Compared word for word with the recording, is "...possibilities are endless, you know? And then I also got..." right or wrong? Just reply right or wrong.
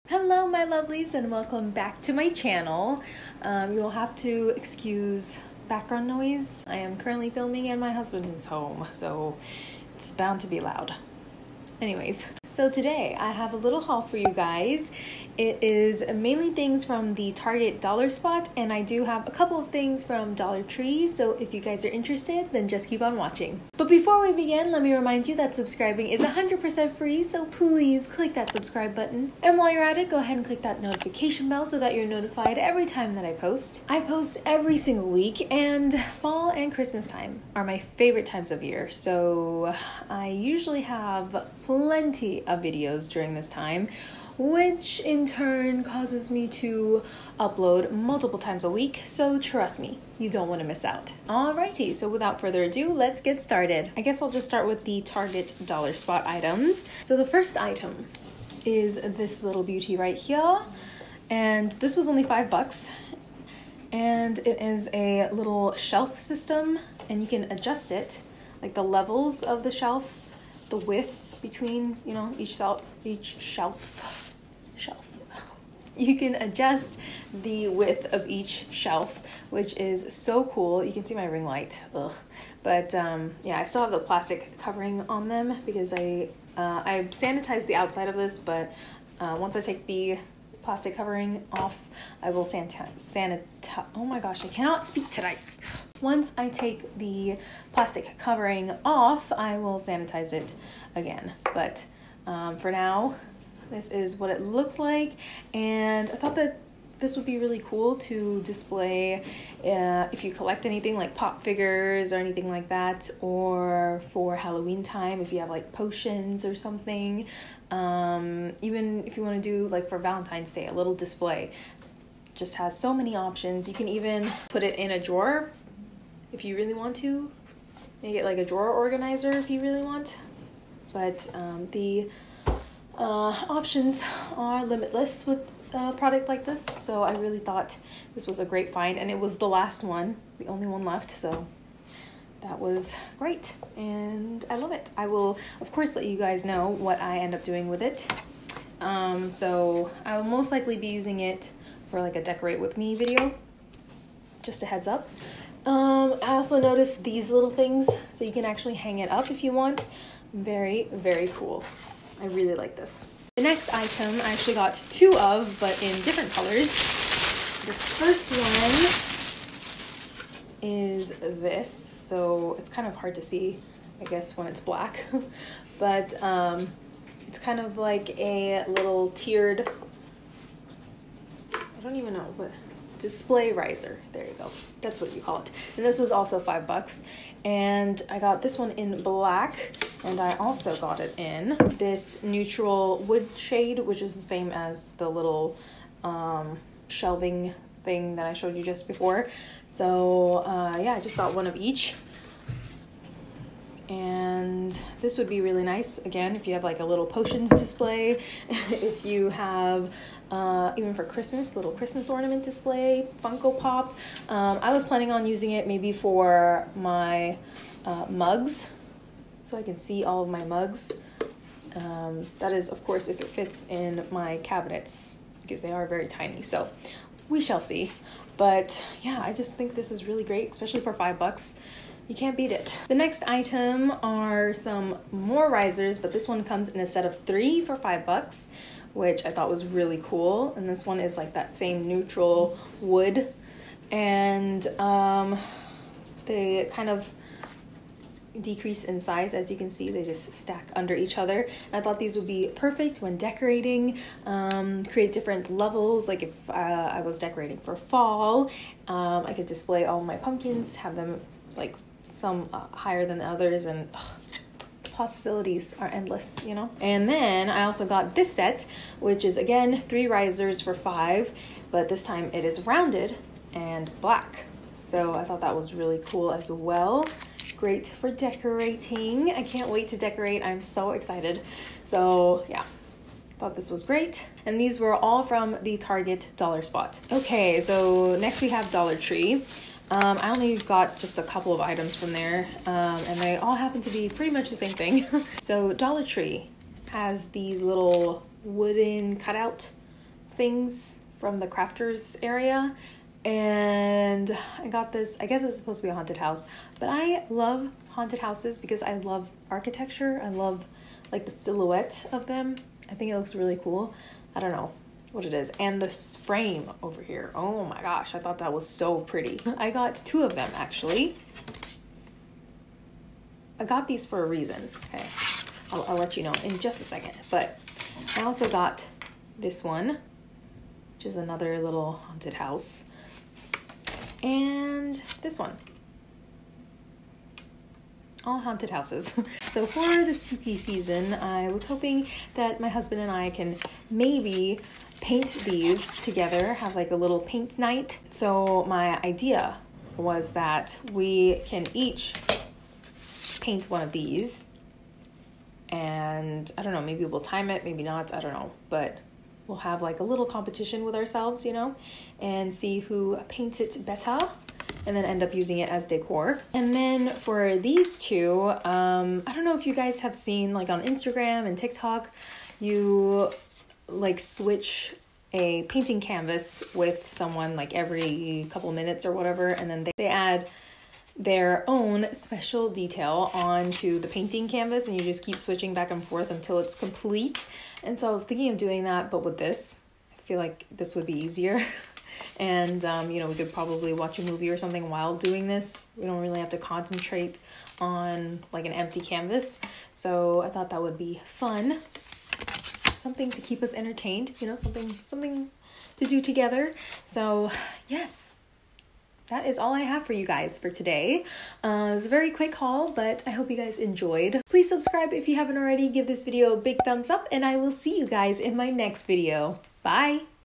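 right.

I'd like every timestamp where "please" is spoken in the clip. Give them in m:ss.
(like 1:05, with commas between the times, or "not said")
0:27, 6:54.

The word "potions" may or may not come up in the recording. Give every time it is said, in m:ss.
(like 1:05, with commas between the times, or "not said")
1:55, 3:27.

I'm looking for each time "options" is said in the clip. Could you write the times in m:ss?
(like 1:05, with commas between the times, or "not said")
2:03, 2:13.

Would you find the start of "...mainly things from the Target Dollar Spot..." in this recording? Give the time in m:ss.
0:16.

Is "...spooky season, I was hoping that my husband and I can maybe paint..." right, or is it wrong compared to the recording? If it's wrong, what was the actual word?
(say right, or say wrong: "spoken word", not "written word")
right.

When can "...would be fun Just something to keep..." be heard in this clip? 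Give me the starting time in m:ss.
6:40.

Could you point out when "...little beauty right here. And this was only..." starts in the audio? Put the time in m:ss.
0:59.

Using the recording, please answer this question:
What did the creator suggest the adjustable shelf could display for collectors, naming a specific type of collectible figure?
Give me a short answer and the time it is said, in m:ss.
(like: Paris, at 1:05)
Pop figures, at 1:51.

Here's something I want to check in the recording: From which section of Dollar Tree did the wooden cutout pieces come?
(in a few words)
Crafters area.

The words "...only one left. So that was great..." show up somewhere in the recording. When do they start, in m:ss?
2:20.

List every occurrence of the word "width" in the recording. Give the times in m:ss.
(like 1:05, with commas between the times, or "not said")
1:10, 1:17.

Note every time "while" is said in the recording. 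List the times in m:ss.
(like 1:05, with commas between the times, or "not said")
0:29, 6:34.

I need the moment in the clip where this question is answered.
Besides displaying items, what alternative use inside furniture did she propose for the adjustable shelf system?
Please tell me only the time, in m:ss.
2:08.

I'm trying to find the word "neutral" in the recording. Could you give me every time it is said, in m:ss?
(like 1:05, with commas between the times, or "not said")
3:12, 4:01.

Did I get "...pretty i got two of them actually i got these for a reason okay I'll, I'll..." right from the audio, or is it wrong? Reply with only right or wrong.
right.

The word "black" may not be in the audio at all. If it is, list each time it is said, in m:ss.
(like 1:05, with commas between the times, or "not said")
2:54, 3:09, 4:34.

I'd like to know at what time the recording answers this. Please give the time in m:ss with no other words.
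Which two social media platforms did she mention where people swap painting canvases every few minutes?
6:10.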